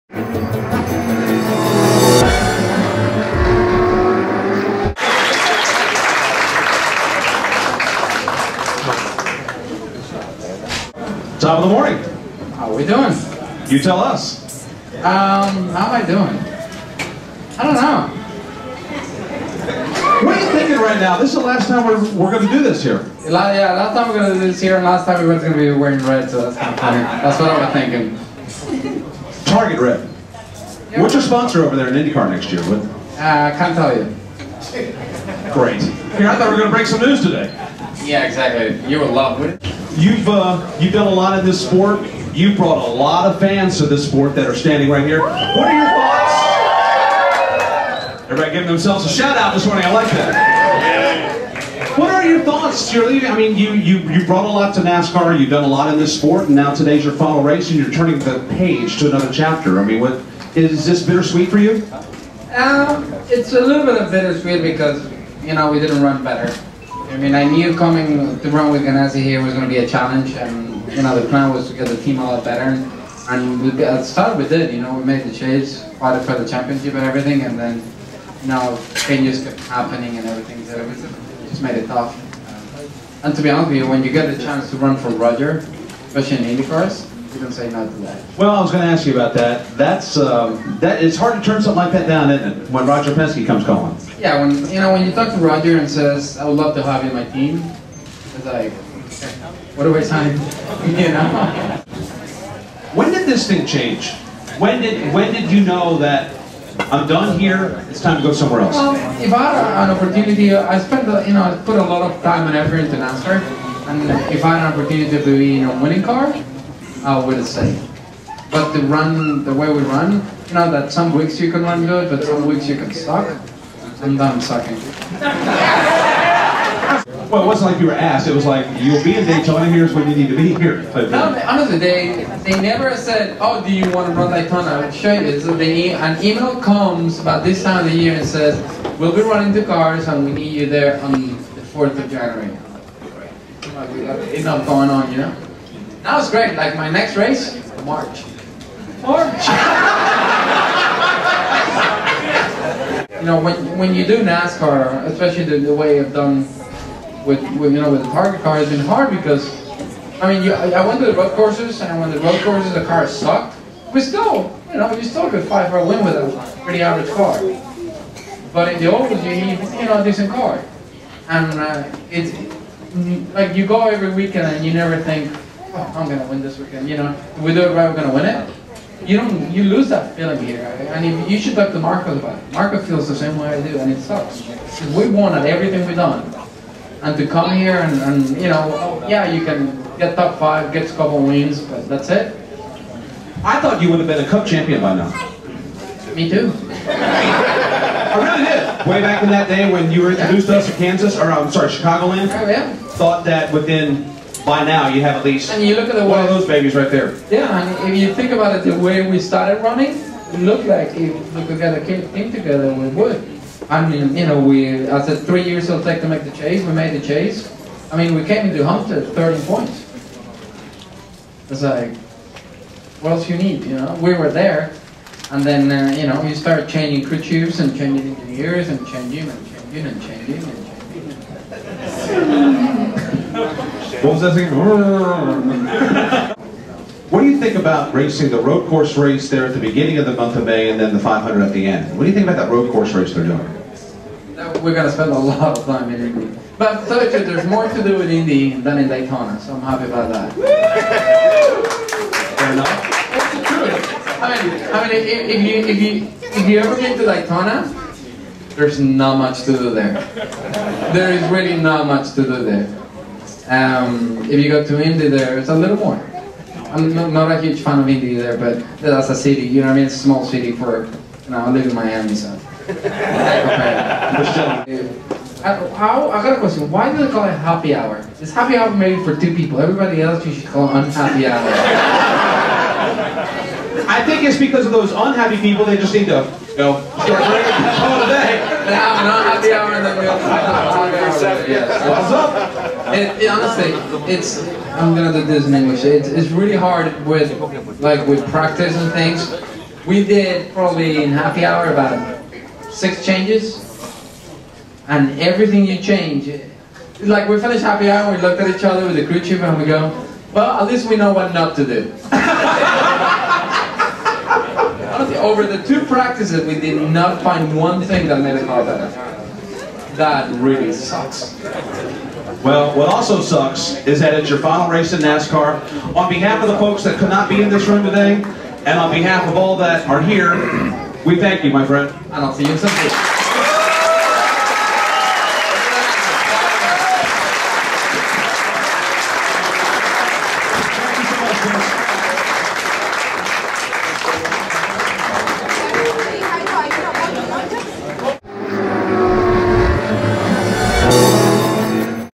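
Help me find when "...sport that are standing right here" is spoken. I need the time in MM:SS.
00:44.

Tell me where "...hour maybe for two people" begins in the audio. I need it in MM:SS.
04:38.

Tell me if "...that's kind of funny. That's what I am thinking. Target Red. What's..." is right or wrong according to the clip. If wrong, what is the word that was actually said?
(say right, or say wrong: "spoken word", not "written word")
right.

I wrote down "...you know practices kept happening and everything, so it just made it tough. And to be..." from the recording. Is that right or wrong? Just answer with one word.
wrong.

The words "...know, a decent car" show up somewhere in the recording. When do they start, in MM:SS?
02:49.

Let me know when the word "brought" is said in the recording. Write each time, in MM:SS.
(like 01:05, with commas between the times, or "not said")
00:42, 00:54.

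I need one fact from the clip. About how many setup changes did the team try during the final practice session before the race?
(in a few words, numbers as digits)
6.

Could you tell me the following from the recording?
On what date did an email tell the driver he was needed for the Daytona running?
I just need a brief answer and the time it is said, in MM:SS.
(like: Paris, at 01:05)
January 4, at 02:21.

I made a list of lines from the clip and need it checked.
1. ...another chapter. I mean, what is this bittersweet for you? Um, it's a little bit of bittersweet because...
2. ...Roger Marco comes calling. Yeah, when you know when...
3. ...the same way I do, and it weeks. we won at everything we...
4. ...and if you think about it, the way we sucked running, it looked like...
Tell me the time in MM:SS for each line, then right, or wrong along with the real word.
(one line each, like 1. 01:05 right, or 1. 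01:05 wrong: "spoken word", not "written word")
1. 00:59 right
2. 01:32 wrong: "Penske", not "Marco"
3. 03:03 wrong: "sucks", not "weeks"
4. 03:27 wrong: "started", not "sucked".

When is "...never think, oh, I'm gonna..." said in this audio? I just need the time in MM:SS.
02:54.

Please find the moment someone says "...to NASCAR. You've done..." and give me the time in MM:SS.
00:54.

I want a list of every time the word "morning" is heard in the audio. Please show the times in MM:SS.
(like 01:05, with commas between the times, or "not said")
00:11, 00:49.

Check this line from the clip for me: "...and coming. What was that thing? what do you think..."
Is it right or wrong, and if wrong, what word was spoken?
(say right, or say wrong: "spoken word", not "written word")
wrong: "changing", not "coming".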